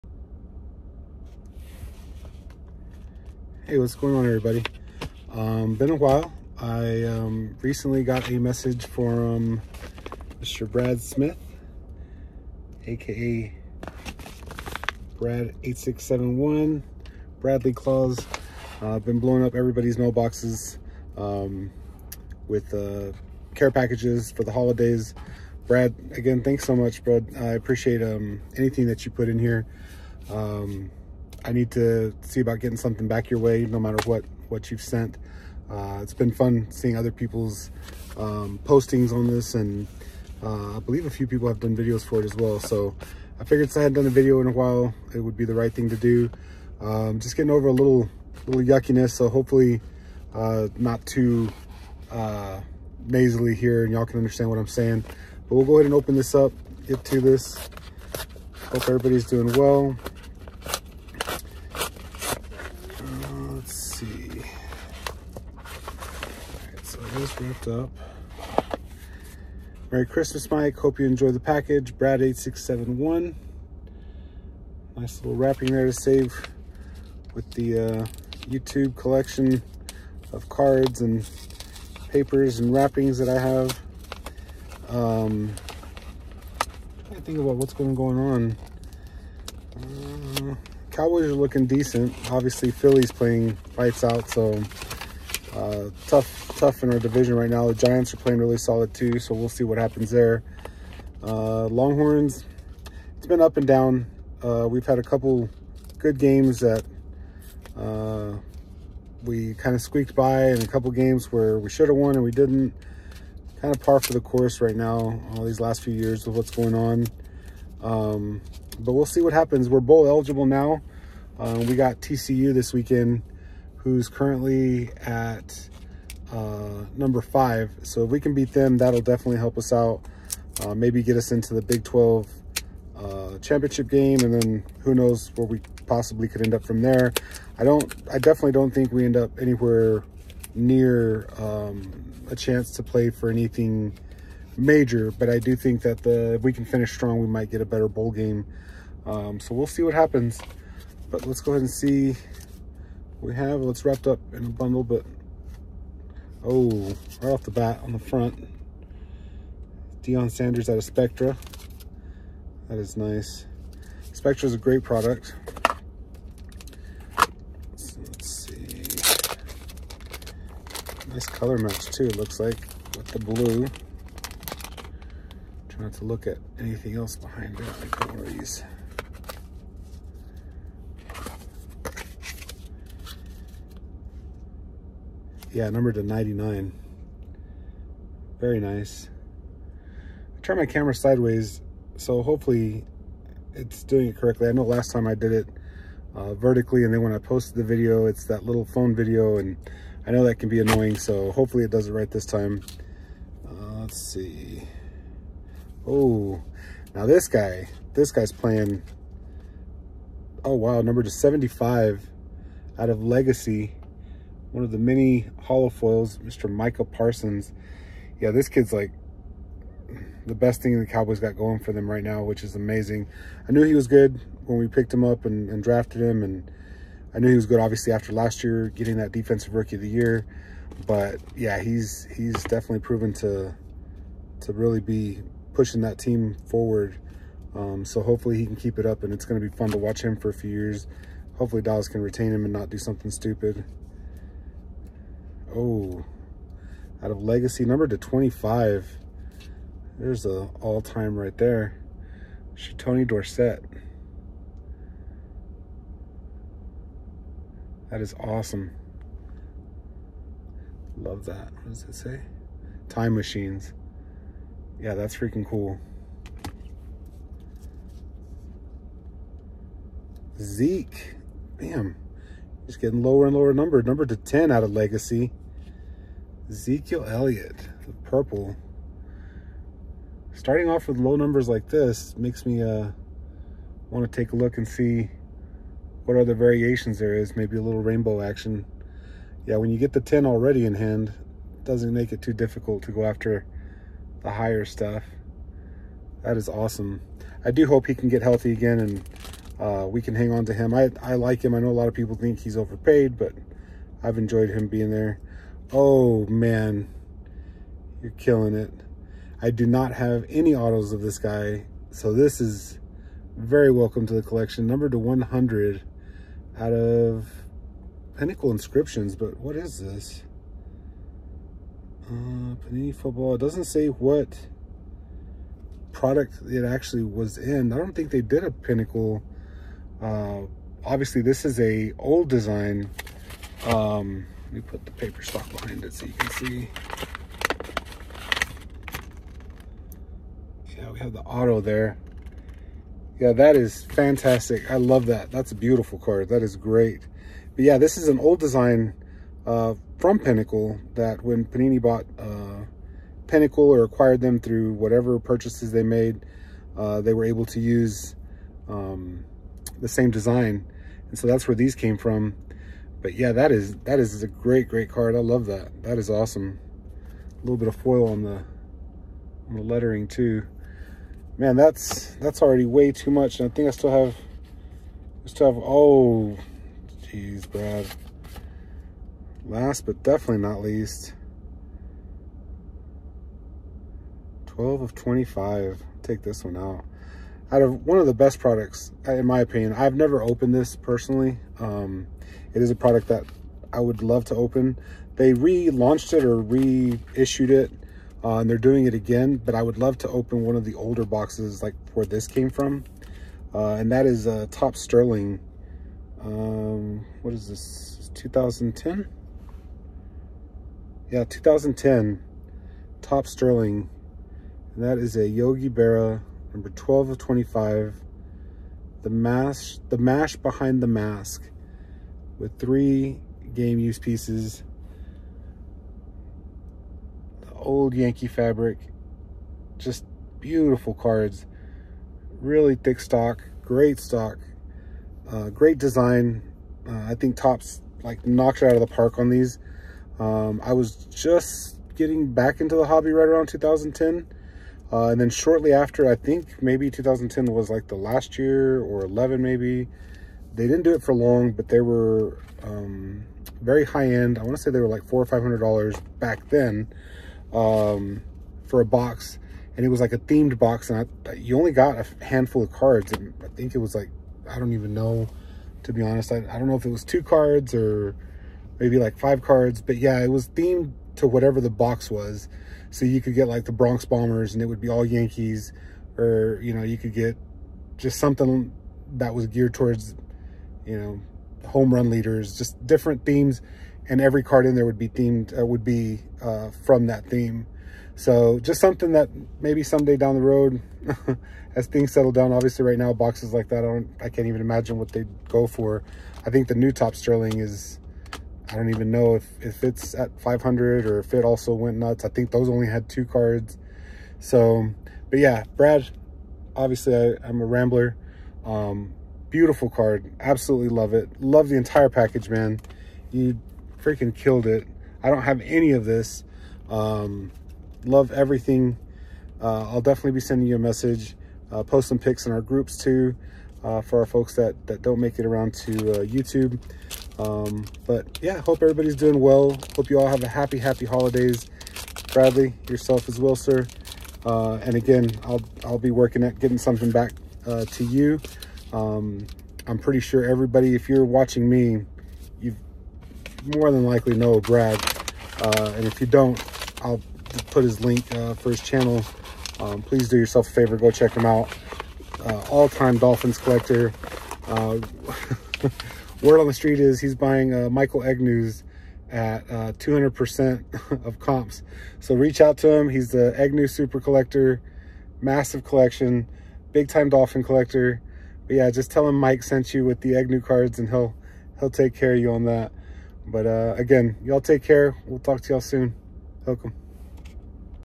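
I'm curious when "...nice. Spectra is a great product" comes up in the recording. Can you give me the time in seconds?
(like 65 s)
162 s.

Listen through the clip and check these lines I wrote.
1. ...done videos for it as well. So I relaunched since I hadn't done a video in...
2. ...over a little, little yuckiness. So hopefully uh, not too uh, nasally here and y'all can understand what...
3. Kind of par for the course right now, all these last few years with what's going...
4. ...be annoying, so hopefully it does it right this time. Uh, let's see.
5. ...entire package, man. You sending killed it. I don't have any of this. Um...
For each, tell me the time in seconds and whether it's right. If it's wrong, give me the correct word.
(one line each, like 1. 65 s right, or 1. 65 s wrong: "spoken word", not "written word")
1. 41 s wrong: "figured", not "relaunched"
2. 47 s right
3. 113 s right
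4. 200 s right
5. 511 s wrong: "freaking", not "sending".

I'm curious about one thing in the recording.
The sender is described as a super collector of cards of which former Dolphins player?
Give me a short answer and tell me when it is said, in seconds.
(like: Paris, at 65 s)
Michael Egnew, at 557 s.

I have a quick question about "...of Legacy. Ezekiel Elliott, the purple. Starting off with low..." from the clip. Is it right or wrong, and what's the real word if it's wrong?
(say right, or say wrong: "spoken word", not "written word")
right.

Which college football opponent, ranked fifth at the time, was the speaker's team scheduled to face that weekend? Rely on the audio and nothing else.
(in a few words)
TCU.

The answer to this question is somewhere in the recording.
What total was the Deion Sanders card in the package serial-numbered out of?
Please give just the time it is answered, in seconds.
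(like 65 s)
185 s.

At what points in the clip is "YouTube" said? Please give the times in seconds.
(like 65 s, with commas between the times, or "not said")
78 s, 526 s.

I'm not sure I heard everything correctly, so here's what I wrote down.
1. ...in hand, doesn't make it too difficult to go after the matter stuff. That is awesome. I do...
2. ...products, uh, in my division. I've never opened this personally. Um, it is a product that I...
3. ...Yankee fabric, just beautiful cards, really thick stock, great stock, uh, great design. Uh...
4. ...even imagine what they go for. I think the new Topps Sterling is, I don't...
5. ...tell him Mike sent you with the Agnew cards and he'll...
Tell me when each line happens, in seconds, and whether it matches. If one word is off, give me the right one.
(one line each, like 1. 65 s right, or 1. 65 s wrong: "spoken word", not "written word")
1. 290 s wrong: "higher", not "matter"
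2. 388 s wrong: "opinion", not "division"
3. 427 s right
4. 494 s right
5. 569 s right.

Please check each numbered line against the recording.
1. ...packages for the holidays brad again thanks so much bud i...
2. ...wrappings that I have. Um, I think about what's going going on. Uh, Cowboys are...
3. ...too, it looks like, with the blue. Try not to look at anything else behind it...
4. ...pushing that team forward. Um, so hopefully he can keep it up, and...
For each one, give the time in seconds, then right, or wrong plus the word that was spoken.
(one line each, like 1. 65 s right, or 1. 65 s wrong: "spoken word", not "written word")
1. 23 s right
2. 82 s right
3. 171 s right
4. 235 s right.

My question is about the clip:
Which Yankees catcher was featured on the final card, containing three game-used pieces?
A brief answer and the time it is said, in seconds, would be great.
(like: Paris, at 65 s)
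Yogi Berra, at 415 s.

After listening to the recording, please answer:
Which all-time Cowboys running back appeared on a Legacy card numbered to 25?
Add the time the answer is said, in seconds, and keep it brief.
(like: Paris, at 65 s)
Tony Dorsett, at 252 s.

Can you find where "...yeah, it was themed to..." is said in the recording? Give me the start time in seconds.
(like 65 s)
469 s.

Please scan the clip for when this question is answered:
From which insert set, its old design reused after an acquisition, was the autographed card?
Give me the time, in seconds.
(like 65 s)
318 s.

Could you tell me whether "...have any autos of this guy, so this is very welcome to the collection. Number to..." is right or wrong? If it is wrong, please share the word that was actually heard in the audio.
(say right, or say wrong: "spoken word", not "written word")
right.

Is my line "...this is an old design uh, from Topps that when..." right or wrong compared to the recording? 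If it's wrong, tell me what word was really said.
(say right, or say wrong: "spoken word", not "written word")
wrong: "Pinnacle", not "Topps".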